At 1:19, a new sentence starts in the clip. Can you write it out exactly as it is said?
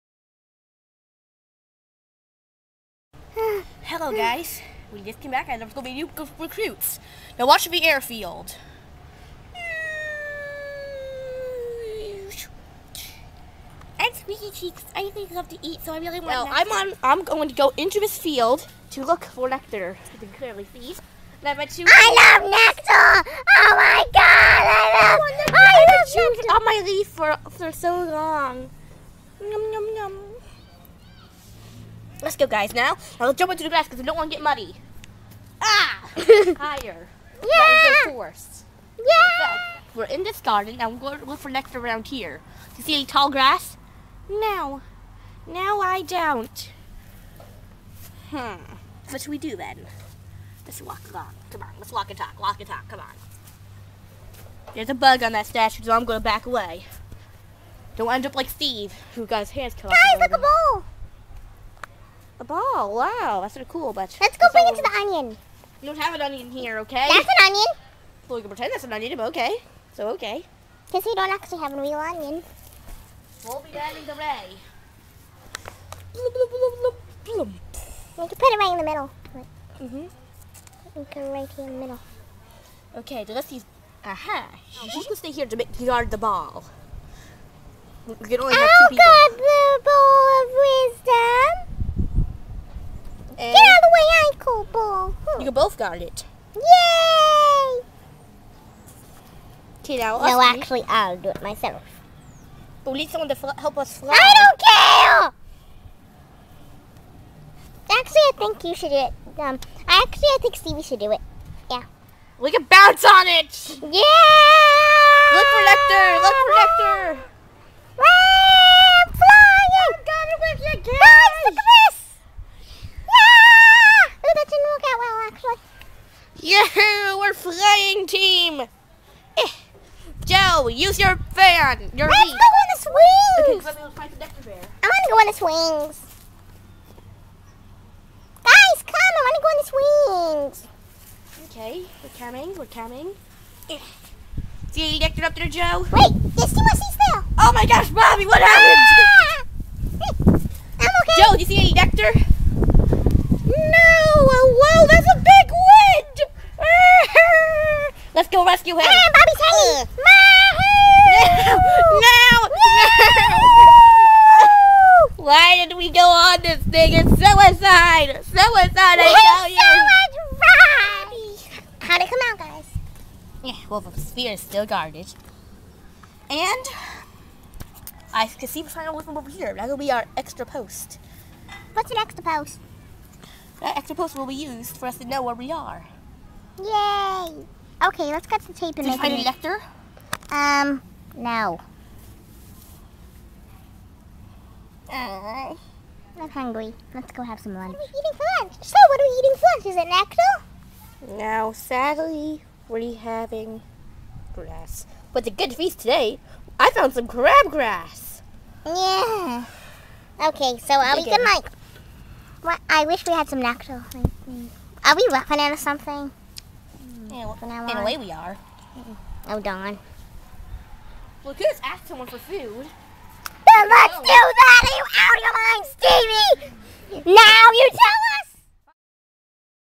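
Mm hmm You can right here in the middle.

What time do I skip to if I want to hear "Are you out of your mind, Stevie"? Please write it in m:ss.
3:44.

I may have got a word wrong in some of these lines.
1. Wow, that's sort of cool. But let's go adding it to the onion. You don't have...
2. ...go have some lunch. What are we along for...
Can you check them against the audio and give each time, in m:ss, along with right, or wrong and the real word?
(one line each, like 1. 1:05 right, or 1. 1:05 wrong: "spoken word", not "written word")
1. 1:02 wrong: "bring", not "adding"
2. 3:17 wrong: "eating", not "along".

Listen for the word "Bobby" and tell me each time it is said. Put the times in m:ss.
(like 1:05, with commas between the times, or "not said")
2:27, 2:39.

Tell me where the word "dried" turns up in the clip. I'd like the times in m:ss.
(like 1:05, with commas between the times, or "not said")
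not said.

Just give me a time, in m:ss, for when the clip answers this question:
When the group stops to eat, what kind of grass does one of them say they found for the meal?
3:27.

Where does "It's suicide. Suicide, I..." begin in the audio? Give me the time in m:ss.
2:46.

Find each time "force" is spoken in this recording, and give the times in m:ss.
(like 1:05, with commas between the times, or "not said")
0:38.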